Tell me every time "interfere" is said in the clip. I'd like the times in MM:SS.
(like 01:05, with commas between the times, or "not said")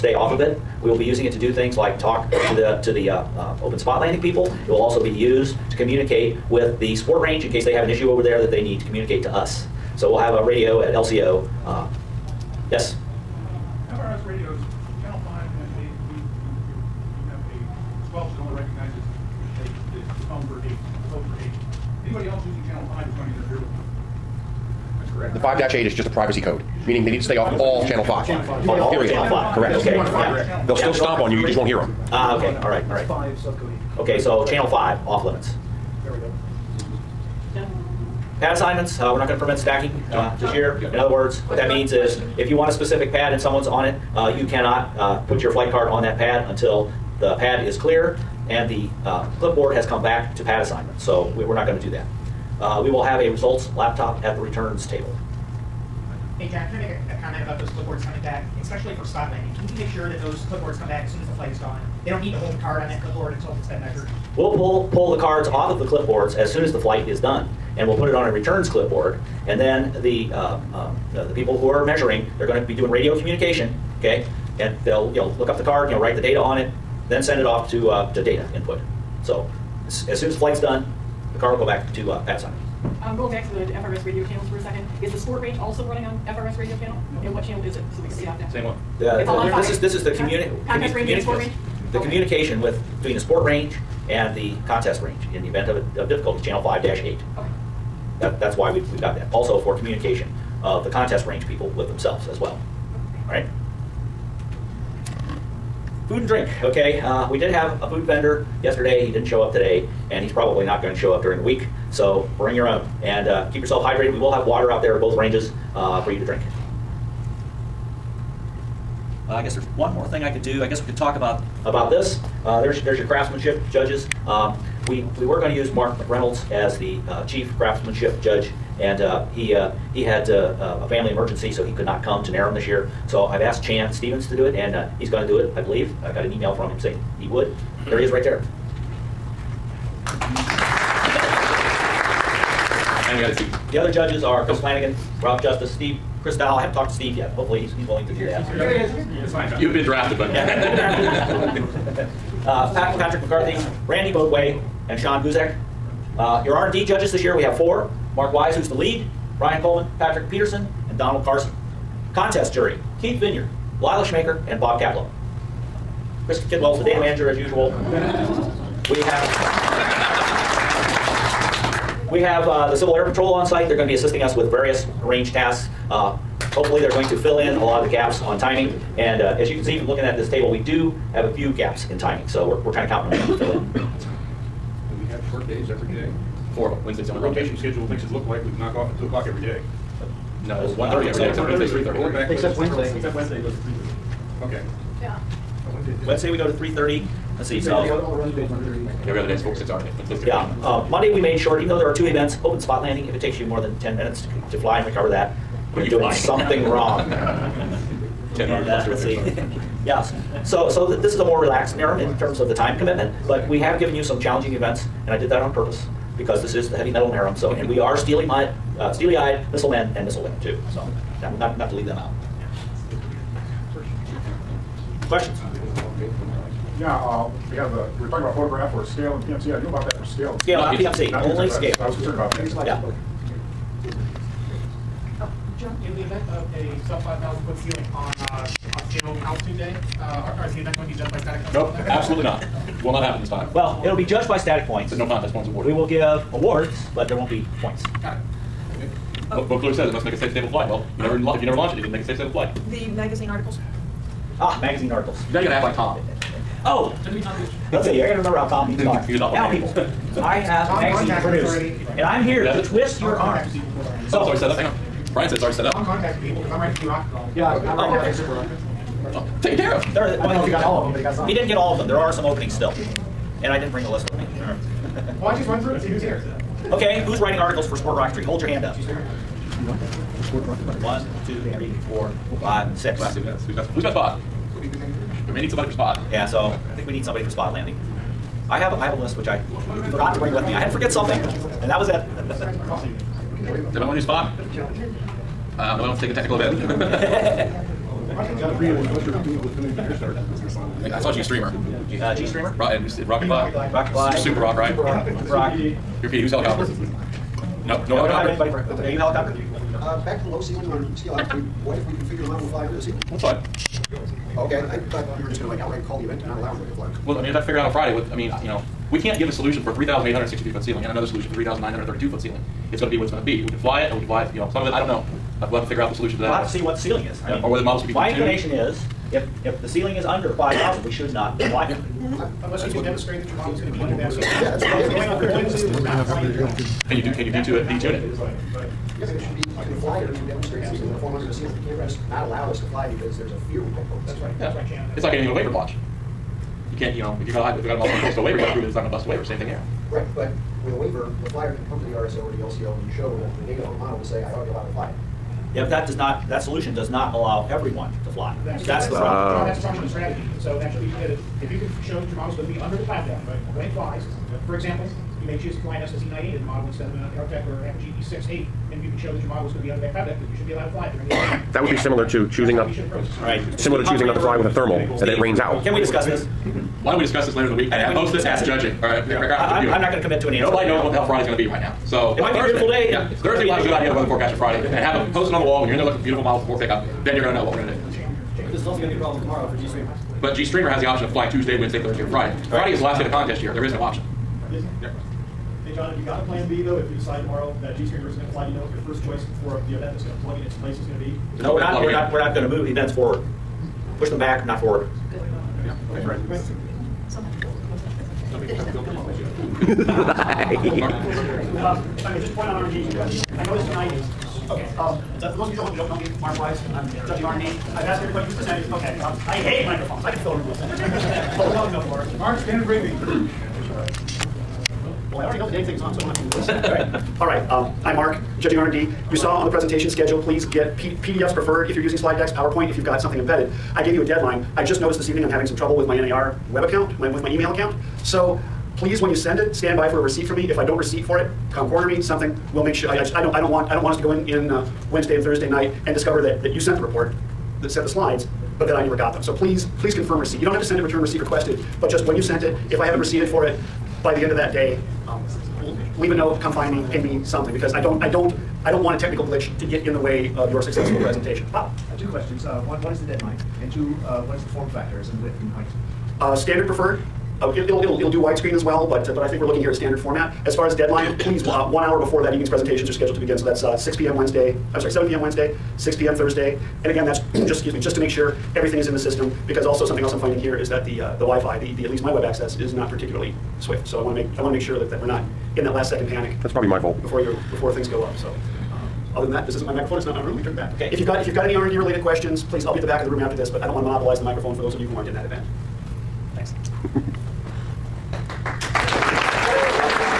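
00:23.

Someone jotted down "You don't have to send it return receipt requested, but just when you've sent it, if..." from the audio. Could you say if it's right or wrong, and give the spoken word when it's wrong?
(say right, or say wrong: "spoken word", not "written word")
right.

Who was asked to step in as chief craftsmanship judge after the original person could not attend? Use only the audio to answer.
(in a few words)
Chan Stevens.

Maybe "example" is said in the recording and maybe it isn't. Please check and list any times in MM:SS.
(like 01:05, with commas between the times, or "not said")
06:04.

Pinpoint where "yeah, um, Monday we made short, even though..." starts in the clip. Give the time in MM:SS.
03:20.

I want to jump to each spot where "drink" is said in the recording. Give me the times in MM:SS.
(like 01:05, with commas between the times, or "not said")
01:46, 01:56.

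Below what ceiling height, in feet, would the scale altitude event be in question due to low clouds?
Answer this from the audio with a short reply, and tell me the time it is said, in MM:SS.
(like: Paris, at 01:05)
5,000 feet, at 03:56.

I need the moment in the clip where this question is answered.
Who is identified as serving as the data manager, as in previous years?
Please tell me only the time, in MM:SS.
02:46.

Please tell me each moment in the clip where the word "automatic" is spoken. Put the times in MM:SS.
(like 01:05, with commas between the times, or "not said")
not said.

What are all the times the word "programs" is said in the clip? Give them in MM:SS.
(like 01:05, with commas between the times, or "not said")
not said.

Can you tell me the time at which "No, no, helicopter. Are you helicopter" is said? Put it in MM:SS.
05:07.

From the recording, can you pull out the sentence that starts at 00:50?
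So we're not going to do that.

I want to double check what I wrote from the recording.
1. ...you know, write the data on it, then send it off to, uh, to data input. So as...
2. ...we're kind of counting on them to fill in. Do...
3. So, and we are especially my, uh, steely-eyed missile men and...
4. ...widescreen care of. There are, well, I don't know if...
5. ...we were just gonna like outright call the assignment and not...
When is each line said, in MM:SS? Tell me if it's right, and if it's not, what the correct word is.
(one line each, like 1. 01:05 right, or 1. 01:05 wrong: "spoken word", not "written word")
1. 01:15 right
2. 03:02 right
3. 03:37 wrong: "steely", not "especially"
4. 04:29 wrong: "taken", not "widescreen"
5. 05:15 wrong: "event", not "assignment".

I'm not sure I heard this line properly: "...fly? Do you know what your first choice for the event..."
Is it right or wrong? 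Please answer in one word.
right.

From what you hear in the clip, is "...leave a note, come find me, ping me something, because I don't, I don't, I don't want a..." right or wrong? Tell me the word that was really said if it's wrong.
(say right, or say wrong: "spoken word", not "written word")
right.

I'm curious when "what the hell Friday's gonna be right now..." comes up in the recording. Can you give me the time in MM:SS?
06:20.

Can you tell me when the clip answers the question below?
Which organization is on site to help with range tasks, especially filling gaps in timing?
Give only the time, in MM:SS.
02:52.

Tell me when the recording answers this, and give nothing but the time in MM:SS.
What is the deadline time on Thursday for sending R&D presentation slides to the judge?
07:55.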